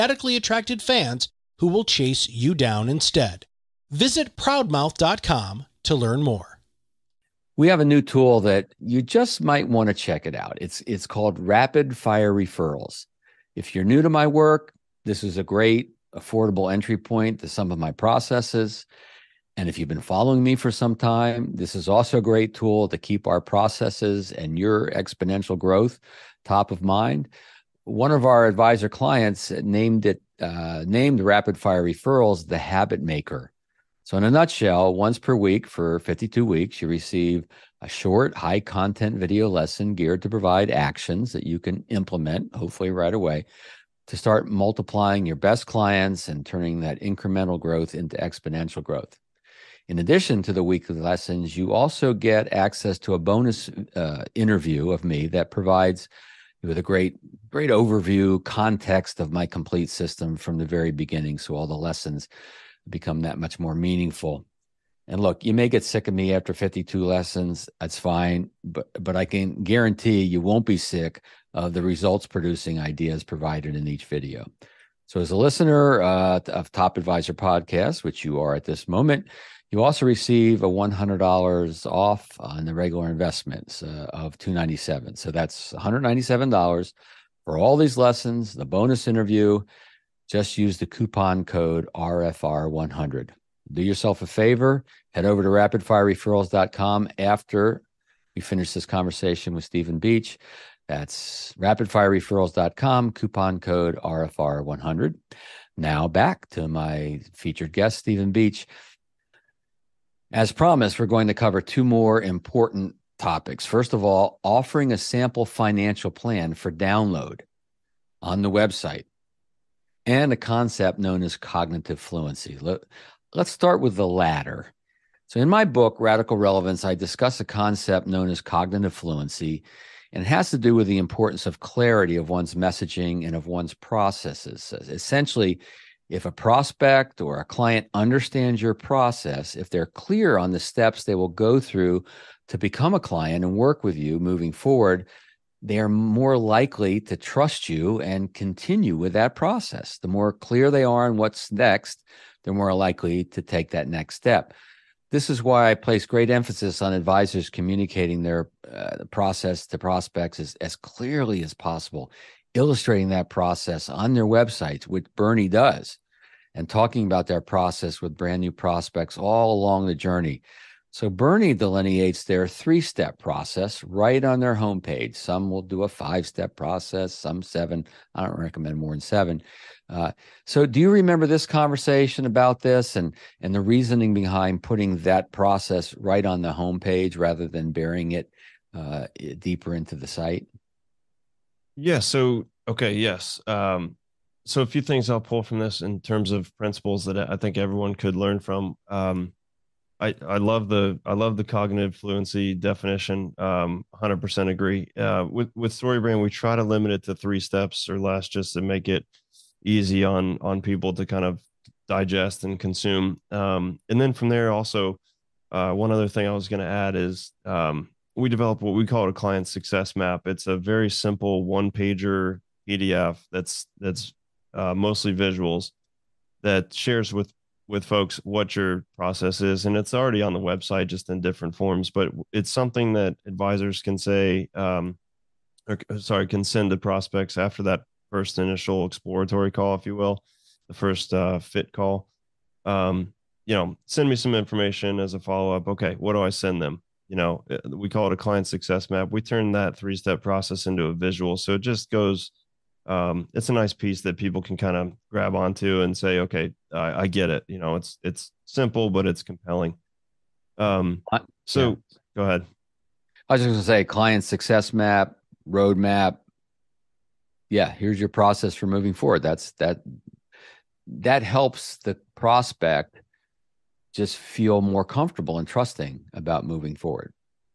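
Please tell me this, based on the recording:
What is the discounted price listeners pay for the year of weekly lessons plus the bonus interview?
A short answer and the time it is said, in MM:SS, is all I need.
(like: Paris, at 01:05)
$197, at 01:25.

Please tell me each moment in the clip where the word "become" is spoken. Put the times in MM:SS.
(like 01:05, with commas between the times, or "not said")
01:02, 02:22.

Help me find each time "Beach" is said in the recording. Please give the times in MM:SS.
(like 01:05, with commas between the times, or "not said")
01:39, 01:48.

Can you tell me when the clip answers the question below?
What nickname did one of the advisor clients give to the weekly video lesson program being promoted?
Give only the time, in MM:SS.
00:32.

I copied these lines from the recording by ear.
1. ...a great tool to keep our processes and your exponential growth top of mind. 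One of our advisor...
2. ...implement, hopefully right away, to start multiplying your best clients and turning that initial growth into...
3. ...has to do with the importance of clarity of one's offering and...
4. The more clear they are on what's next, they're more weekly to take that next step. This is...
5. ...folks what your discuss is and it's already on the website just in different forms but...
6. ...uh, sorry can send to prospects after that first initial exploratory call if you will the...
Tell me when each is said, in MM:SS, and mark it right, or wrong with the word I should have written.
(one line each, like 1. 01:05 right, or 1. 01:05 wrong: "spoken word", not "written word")
1. 00:22 right
2. 00:41 wrong: "incremental", not "initial"
3. 02:10 wrong: "messaging", not "offering"
4. 02:29 wrong: "likely", not "weekly"
5. 03:47 wrong: "process", not "discuss"
6. 03:55 right.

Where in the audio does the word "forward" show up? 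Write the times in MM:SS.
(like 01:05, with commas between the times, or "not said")
02:24, 04:28, 04:36.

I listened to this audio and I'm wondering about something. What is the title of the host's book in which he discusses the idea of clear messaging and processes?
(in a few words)
Radical Relevance.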